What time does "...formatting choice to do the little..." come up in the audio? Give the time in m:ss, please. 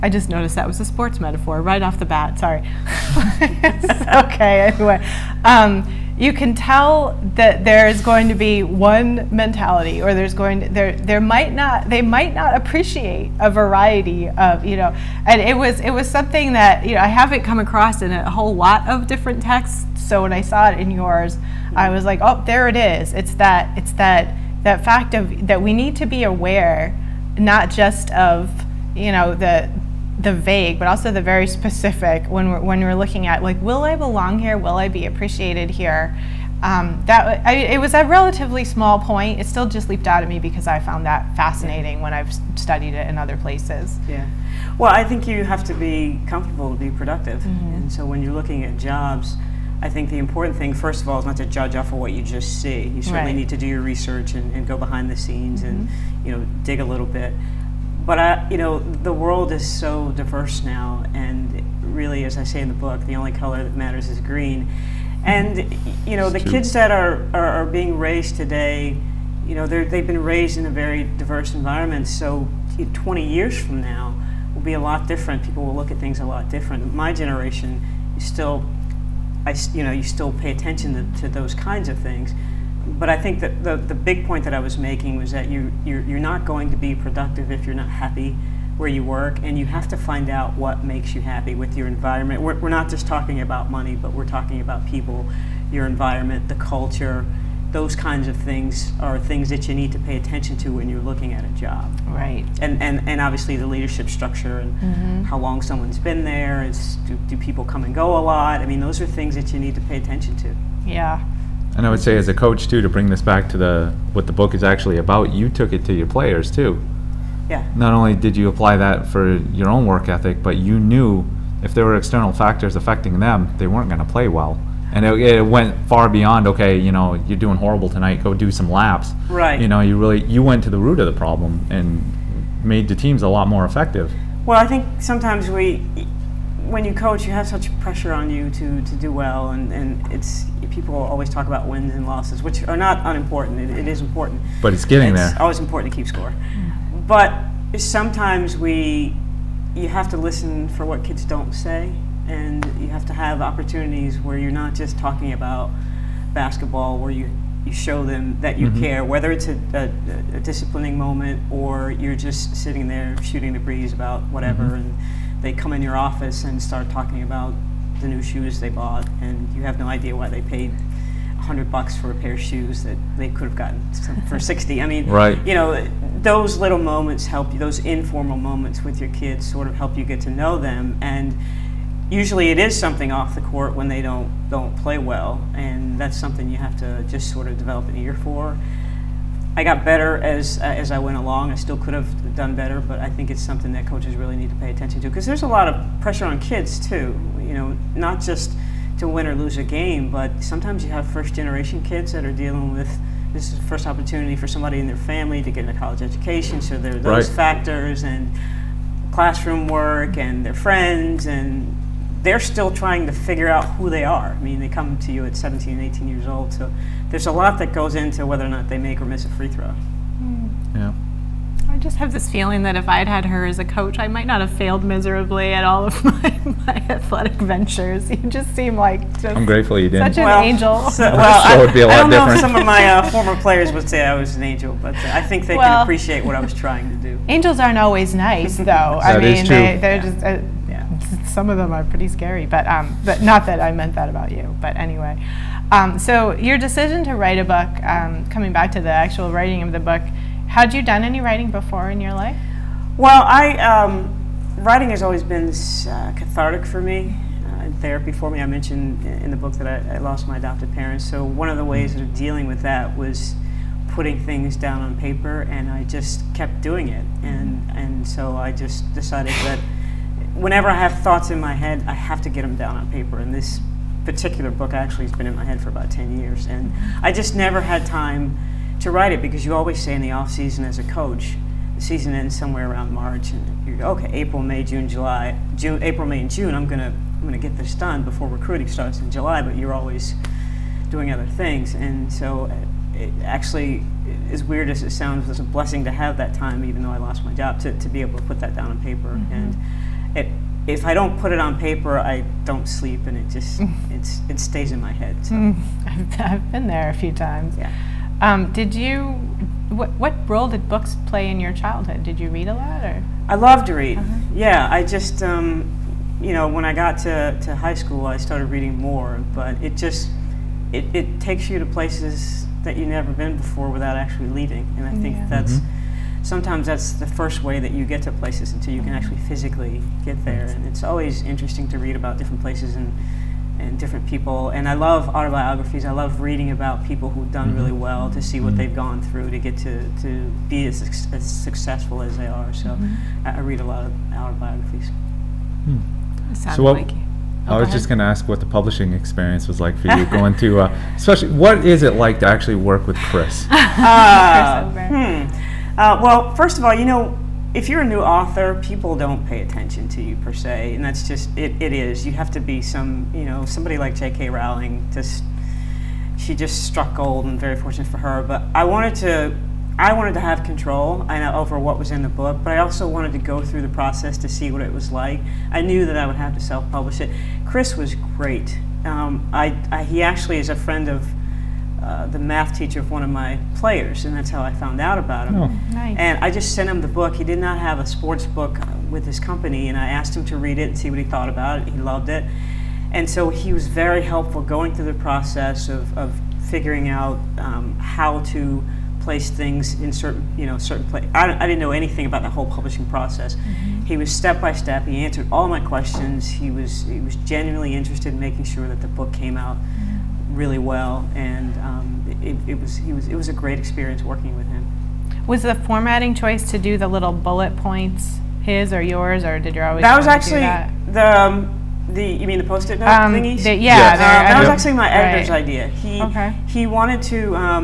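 6:55.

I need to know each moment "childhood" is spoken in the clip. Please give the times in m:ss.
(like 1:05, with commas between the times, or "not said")
5:11.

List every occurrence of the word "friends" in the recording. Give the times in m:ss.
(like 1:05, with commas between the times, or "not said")
3:30, 6:20.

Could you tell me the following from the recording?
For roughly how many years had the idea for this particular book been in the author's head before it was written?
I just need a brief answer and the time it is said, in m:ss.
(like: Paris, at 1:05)
10 years, at 4:35.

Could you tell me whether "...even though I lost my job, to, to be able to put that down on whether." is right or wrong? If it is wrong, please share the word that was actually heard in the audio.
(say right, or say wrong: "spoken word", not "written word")
wrong: "paper", not "whether".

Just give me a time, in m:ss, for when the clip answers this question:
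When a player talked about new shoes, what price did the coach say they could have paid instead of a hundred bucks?
2:54.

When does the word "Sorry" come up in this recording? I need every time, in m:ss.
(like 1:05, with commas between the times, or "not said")
0:02.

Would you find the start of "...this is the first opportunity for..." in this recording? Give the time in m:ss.
3:23.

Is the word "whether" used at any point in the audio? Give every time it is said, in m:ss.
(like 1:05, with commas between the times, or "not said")
2:39, 3:38.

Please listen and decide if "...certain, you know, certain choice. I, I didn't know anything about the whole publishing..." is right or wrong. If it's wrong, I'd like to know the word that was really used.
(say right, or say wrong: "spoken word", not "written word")
wrong: "place", not "choice".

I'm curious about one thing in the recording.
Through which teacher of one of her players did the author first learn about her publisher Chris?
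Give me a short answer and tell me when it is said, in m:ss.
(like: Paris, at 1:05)
The math teacher, at 6:22.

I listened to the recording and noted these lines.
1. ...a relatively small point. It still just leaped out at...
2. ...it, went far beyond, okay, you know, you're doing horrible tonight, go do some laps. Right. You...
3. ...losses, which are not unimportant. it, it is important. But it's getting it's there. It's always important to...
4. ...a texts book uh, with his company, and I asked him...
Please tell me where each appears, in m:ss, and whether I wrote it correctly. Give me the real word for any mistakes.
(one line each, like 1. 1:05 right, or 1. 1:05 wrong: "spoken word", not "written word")
1. 0:37 right
2. 2:05 right
3. 2:22 right
4. 6:27 wrong: "sports", not "texts".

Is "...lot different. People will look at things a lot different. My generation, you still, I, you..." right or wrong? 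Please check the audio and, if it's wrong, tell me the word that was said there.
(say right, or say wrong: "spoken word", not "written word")
right.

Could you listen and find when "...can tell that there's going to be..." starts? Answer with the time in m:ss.
0:06.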